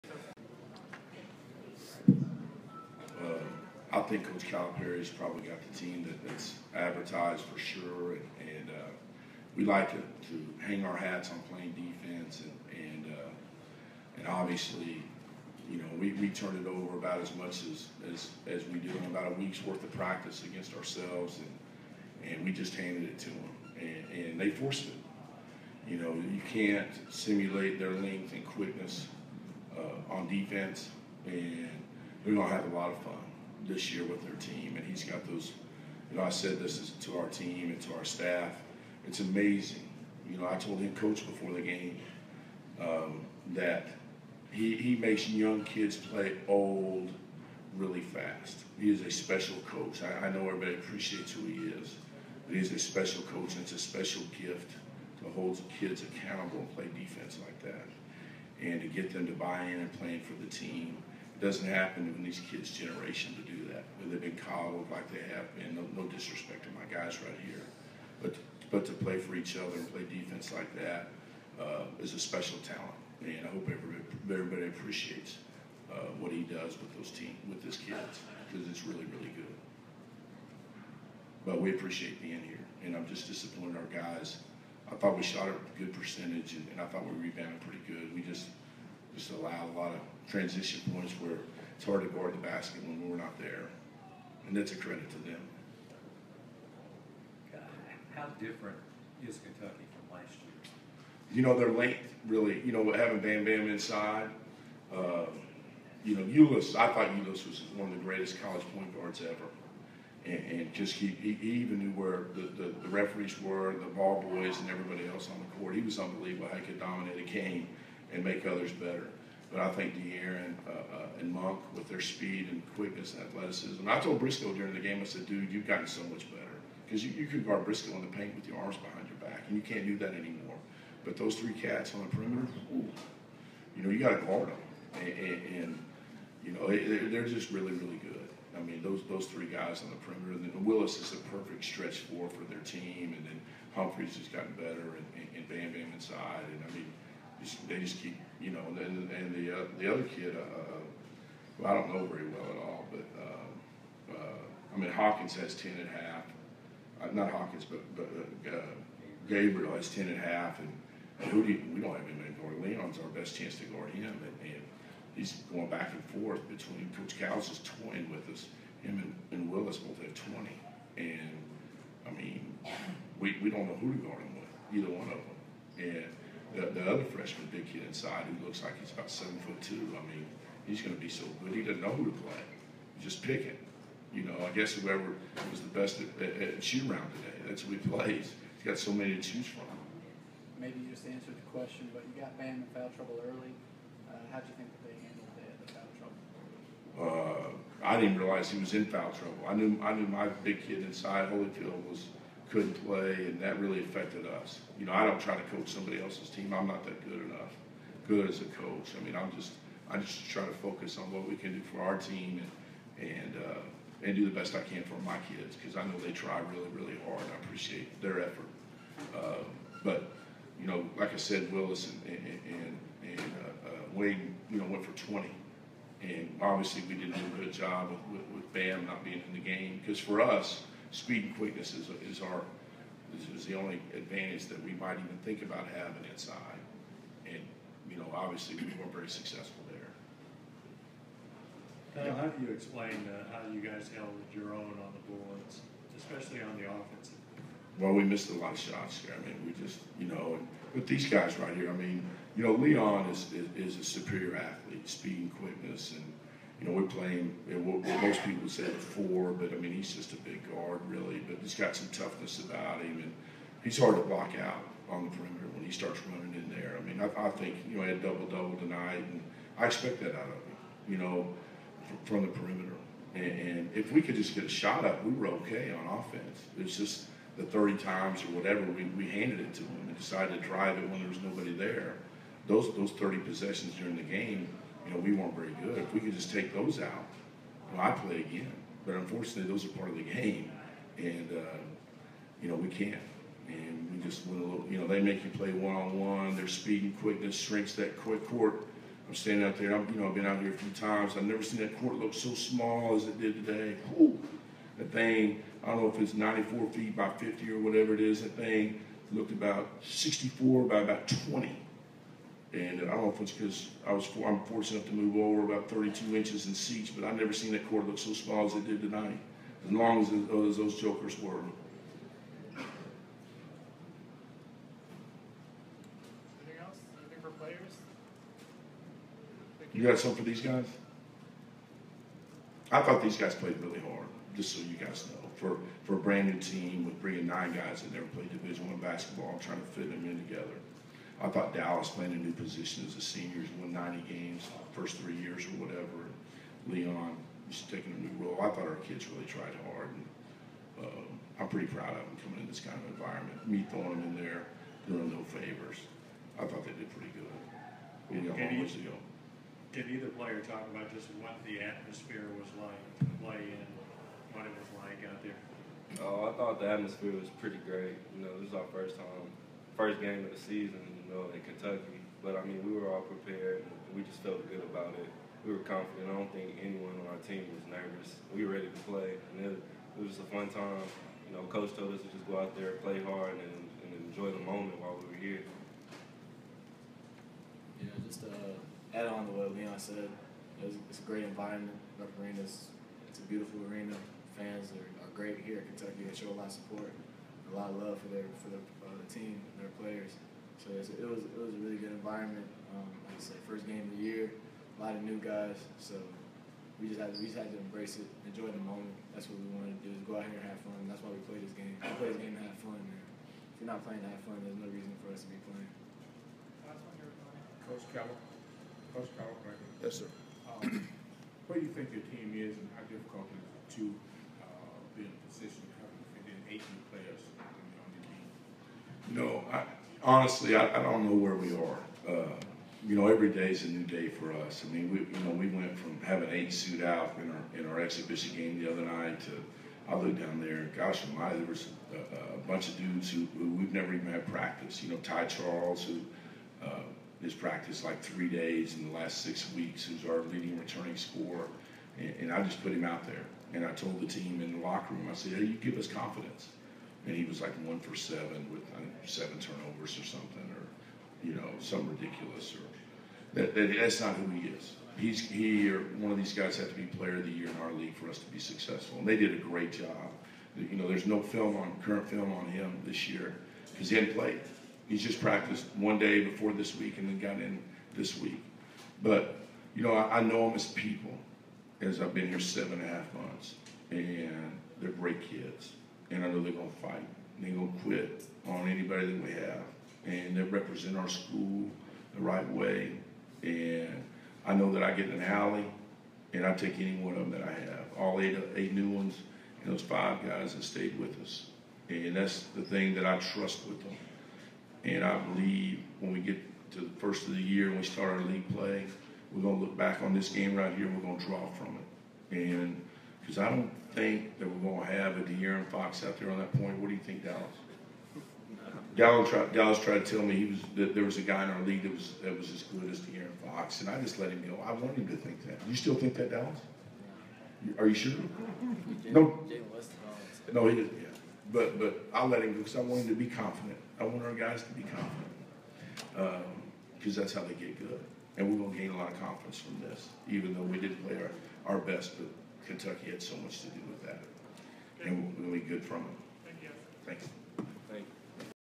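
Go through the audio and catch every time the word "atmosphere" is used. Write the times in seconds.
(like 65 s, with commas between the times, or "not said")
361 s, 366 s.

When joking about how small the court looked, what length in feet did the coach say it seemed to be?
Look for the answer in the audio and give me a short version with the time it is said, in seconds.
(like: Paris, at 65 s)
64, at 309 s.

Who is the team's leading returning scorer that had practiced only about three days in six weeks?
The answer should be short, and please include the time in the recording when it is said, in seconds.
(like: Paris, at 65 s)
Ty Charles, at 444 s.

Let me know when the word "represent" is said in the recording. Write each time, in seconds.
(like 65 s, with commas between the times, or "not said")
490 s.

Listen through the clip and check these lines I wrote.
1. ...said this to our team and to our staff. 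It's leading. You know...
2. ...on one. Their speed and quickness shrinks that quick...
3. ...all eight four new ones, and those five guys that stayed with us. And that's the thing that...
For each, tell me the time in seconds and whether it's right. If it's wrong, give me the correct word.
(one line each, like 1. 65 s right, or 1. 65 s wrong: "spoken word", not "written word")
1. 36 s wrong: "amazing", not "leading"
2. 295 s right
3. 497 s wrong: "eight", not "four".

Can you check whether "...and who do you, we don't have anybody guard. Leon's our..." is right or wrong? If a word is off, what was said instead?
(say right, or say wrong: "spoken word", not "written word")
right.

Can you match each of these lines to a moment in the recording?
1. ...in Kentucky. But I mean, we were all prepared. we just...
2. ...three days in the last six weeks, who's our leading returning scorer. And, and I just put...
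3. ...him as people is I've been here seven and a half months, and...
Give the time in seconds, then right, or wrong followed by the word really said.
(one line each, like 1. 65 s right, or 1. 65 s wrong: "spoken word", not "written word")
1. 371 s right
2. 448 s right
3. 480 s right.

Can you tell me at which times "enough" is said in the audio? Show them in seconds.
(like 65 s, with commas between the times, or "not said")
207 s, 314 s.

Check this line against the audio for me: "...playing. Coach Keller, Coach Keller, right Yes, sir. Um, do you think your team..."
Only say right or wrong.
right.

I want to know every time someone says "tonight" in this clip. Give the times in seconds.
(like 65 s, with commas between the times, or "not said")
268 s, 318 s.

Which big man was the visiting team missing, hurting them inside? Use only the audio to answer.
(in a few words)
Holyfield.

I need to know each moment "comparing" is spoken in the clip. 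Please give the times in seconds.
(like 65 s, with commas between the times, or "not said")
not said.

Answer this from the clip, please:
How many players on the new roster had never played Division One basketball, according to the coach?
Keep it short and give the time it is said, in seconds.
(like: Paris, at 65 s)
9, at 337 s.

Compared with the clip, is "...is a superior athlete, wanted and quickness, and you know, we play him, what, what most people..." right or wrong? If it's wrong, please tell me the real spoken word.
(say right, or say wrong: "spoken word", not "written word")
wrong: "speed", not "wanted".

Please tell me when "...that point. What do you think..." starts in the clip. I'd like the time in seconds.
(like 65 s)
516 s.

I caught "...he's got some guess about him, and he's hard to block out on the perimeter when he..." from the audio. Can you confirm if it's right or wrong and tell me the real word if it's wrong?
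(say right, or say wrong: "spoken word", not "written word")
wrong: "toughness", not "guess".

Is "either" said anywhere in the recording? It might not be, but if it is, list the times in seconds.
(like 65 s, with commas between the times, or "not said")
174 s, 359 s.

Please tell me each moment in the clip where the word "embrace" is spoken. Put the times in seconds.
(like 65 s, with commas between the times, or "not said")
407 s.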